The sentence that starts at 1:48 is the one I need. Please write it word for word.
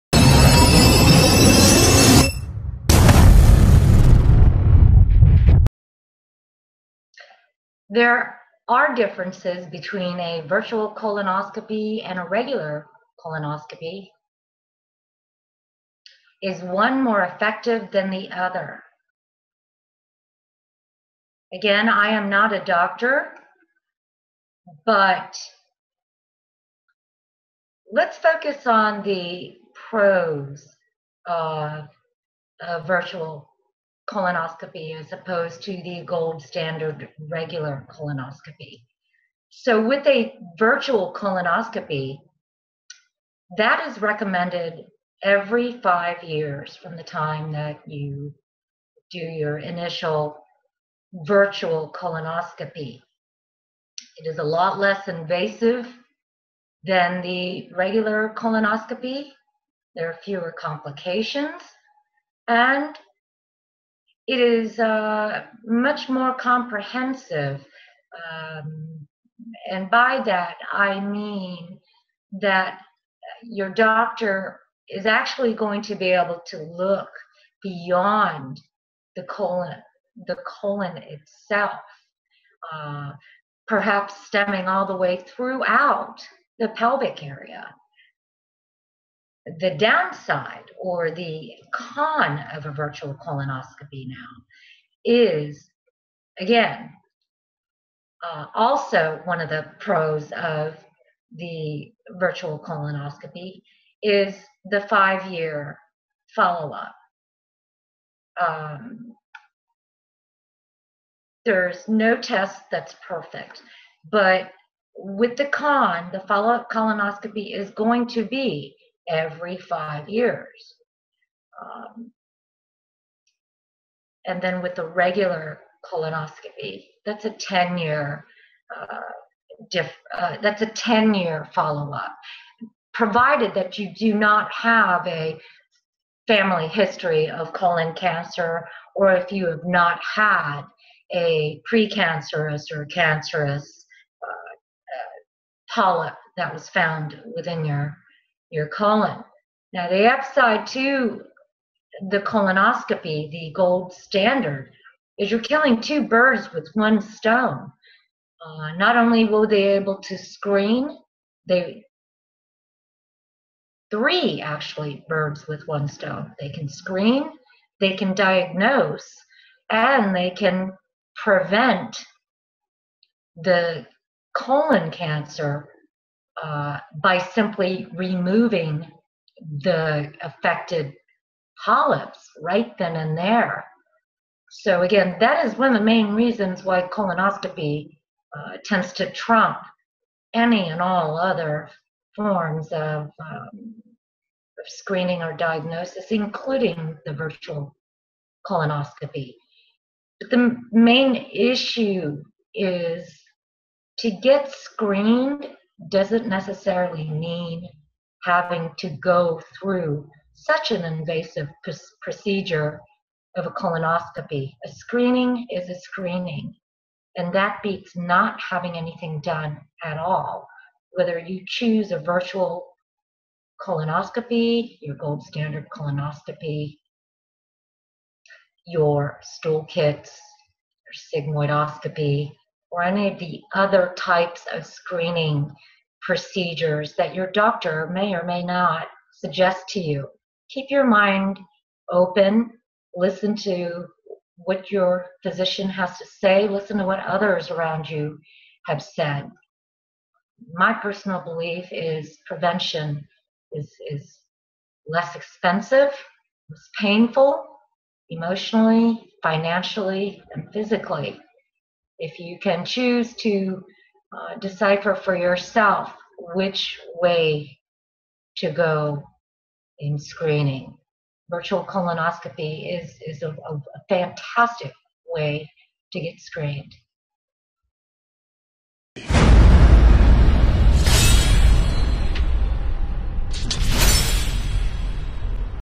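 Um, there's no test that's perfect, but with the con, the follow up colonoscopy is going to be every five years.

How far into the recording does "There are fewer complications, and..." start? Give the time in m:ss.
0:59.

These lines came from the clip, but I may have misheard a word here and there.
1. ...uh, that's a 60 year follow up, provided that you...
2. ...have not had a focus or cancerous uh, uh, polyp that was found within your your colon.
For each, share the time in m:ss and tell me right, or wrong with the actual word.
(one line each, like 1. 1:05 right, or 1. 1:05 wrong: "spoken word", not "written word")
1. 2:10 wrong: "10", not "60"
2. 2:19 wrong: "precancerous", not "focus".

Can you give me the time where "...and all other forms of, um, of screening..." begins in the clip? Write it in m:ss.
3:10.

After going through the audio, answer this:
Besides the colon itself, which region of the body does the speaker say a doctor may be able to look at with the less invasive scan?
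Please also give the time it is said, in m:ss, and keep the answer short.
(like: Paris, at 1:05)
Pelvic area, at 1:26.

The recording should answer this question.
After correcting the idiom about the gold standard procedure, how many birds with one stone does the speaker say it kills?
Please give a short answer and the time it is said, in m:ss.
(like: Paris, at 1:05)
3, at 2:43.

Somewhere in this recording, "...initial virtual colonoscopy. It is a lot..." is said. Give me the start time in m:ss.
0:49.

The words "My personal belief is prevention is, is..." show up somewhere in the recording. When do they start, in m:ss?
4:10.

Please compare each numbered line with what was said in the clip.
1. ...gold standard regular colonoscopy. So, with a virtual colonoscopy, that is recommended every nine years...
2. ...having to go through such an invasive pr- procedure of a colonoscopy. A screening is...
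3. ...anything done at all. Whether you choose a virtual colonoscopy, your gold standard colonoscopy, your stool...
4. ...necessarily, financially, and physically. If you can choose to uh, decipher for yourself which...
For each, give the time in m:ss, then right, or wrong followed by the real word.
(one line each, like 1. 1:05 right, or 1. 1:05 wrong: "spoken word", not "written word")
1. 0:36 wrong: "five", not "nine"
2. 3:28 right
3. 3:38 right
4. 4:18 wrong: "emotionally", not "necessarily".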